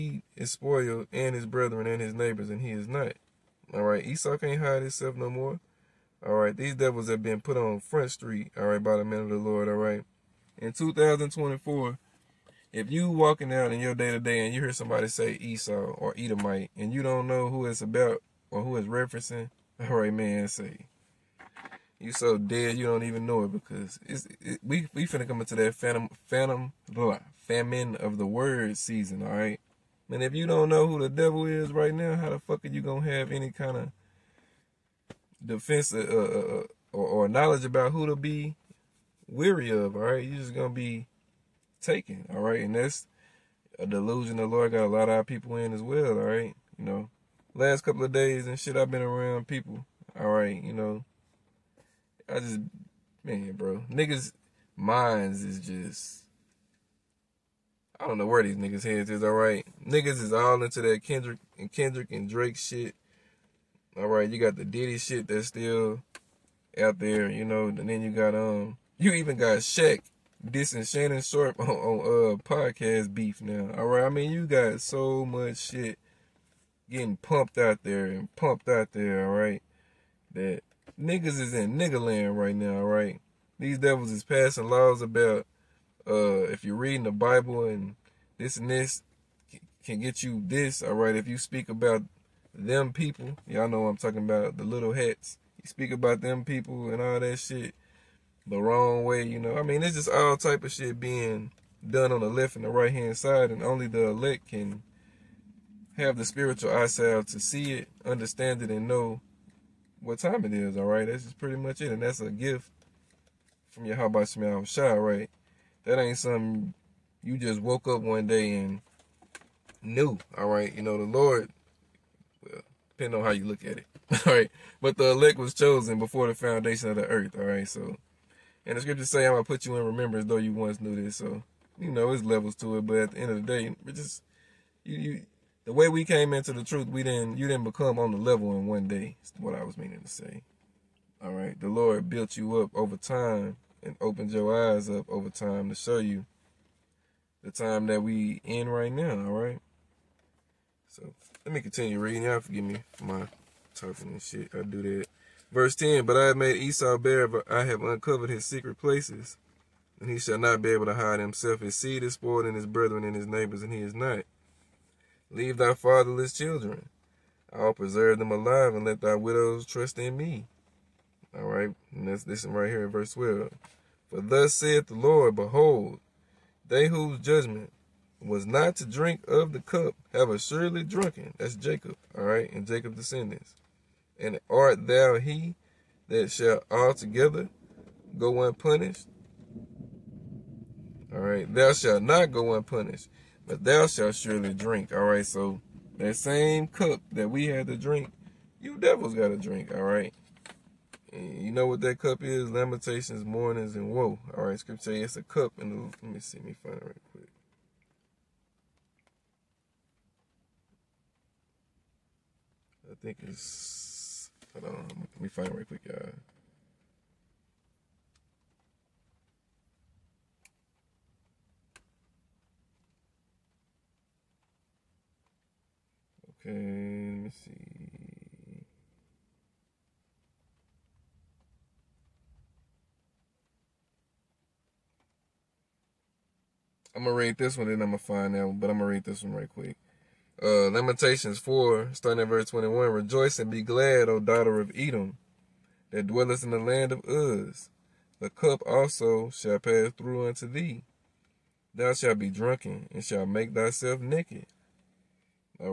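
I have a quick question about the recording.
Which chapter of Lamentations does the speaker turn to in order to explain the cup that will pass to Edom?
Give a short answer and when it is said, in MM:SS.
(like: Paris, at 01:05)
Lamentations 4, at 04:00.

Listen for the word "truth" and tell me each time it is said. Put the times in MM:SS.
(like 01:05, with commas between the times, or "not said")
02:16.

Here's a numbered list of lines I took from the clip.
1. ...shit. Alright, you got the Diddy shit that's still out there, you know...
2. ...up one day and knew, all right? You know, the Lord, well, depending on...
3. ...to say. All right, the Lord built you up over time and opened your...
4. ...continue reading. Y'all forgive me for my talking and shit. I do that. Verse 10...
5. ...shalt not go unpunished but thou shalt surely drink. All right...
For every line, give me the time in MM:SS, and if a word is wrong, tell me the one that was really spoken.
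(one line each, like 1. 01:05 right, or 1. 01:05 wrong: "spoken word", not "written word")
1. 01:02 right
2. 01:57 right
3. 02:20 right
4. 02:31 right
5. 03:11 right.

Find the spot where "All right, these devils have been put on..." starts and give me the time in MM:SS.
00:06.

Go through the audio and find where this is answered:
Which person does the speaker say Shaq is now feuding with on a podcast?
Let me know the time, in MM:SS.
01:10.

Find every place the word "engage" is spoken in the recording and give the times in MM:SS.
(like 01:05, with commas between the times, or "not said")
not said.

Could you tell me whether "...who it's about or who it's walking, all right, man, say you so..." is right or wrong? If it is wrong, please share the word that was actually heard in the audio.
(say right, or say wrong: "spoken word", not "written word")
wrong: "referencing", not "walking".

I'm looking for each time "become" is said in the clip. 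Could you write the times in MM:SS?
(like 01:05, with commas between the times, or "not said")
02:17.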